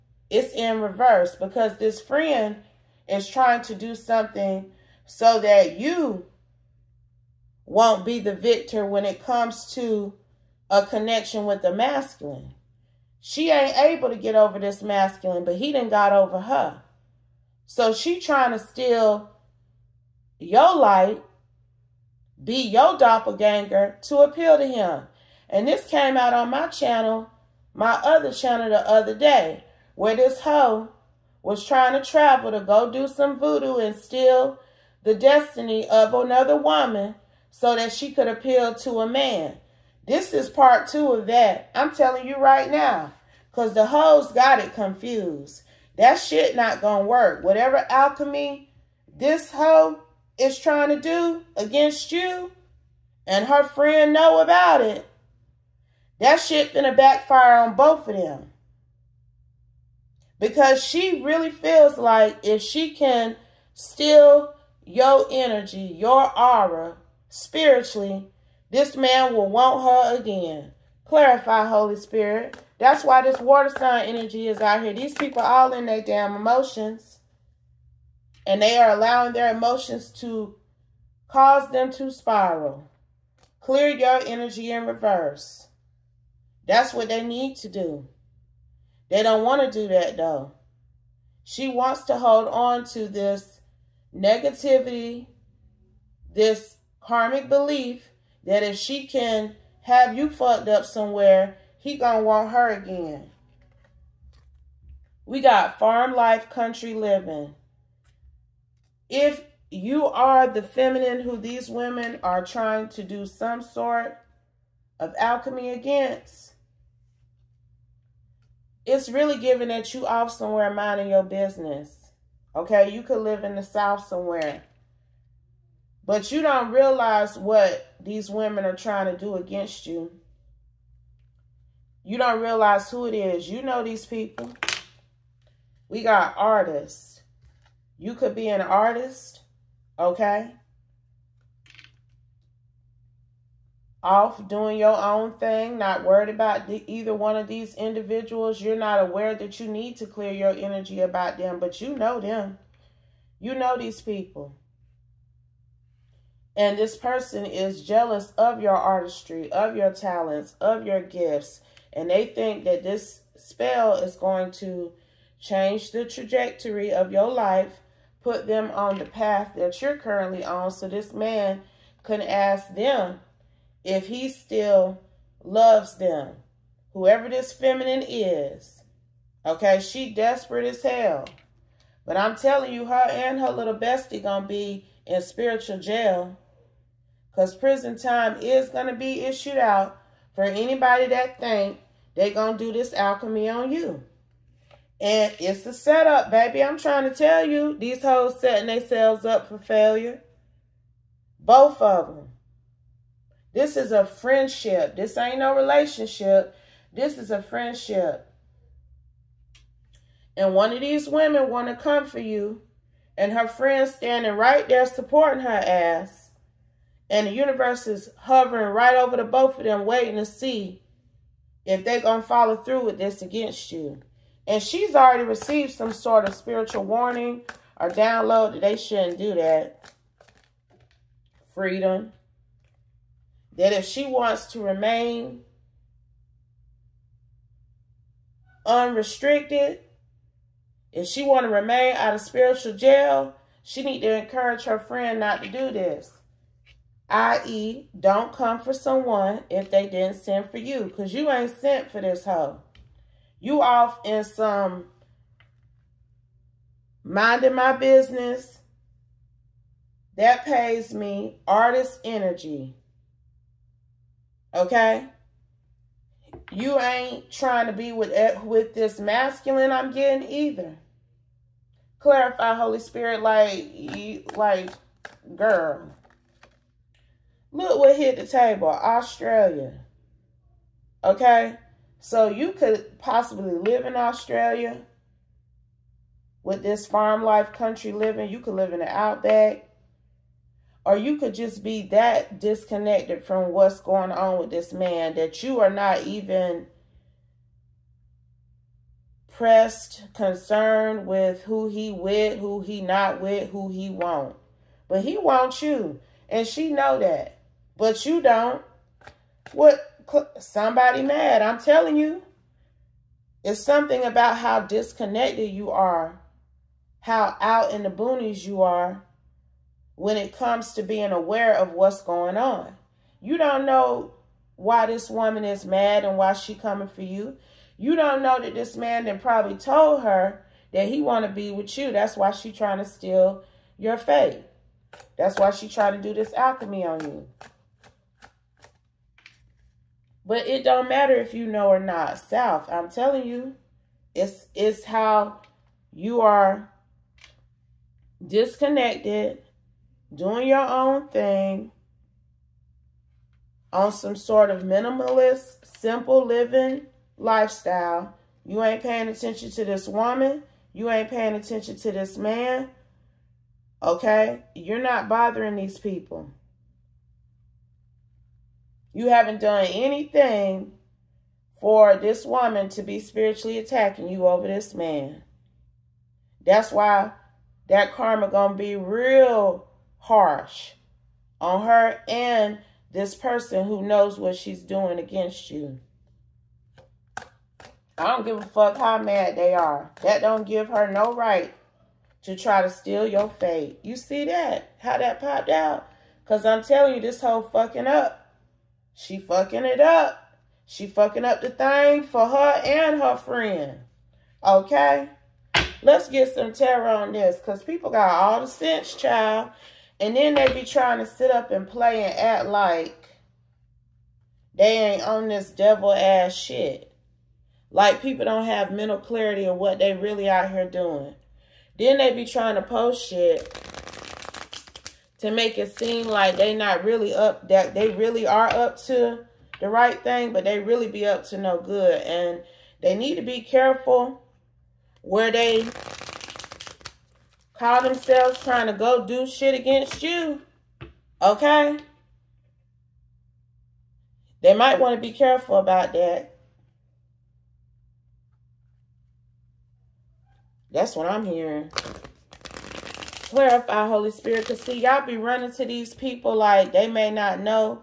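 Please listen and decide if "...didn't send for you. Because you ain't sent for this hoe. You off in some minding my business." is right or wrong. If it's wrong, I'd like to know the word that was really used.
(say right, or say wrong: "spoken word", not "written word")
right.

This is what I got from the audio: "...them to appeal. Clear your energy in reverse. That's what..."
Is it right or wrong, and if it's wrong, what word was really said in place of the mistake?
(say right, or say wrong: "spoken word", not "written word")
wrong: "spiral", not "appeal".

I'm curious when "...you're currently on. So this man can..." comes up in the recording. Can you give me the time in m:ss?
2:49.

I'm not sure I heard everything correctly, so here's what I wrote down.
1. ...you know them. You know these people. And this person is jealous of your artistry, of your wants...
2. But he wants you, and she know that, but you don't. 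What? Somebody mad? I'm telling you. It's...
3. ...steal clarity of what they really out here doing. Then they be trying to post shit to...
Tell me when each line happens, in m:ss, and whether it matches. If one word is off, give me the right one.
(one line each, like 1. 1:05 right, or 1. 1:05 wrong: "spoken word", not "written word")
1. 2:31 wrong: "talents", not "wants"
2. 5:04 right
3. 6:58 wrong: "mental", not "steal".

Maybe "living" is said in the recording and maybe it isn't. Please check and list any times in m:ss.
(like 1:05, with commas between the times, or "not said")
1:46, 4:47, 5:56.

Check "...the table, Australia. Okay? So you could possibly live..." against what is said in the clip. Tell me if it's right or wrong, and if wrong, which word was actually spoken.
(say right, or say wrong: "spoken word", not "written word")
right.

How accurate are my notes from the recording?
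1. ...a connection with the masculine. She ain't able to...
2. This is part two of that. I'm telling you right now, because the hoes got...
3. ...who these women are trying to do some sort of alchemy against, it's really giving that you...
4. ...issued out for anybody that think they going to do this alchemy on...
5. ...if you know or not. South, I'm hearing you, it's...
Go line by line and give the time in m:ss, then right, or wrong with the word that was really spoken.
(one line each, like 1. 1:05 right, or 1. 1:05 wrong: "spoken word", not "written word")
1. 0:10 right
2. 0:40 right
3. 1:51 right
4. 3:09 right
5. 5:41 wrong: "telling", not "hearing".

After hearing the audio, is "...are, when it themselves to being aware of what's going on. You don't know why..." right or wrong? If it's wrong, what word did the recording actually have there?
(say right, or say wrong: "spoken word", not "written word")
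wrong: "comes", not "themselves".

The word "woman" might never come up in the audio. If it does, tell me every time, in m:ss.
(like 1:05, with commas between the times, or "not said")
0:36, 5:25, 5:59, 6:12.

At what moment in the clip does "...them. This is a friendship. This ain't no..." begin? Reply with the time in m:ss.
3:22.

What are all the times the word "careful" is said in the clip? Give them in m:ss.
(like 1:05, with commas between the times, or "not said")
7:13, 7:25.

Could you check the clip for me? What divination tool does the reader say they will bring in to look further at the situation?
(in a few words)
Tarot.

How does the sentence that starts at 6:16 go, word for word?
That's why that karma going to be real harsh on her and this person who knows what she's doing against you.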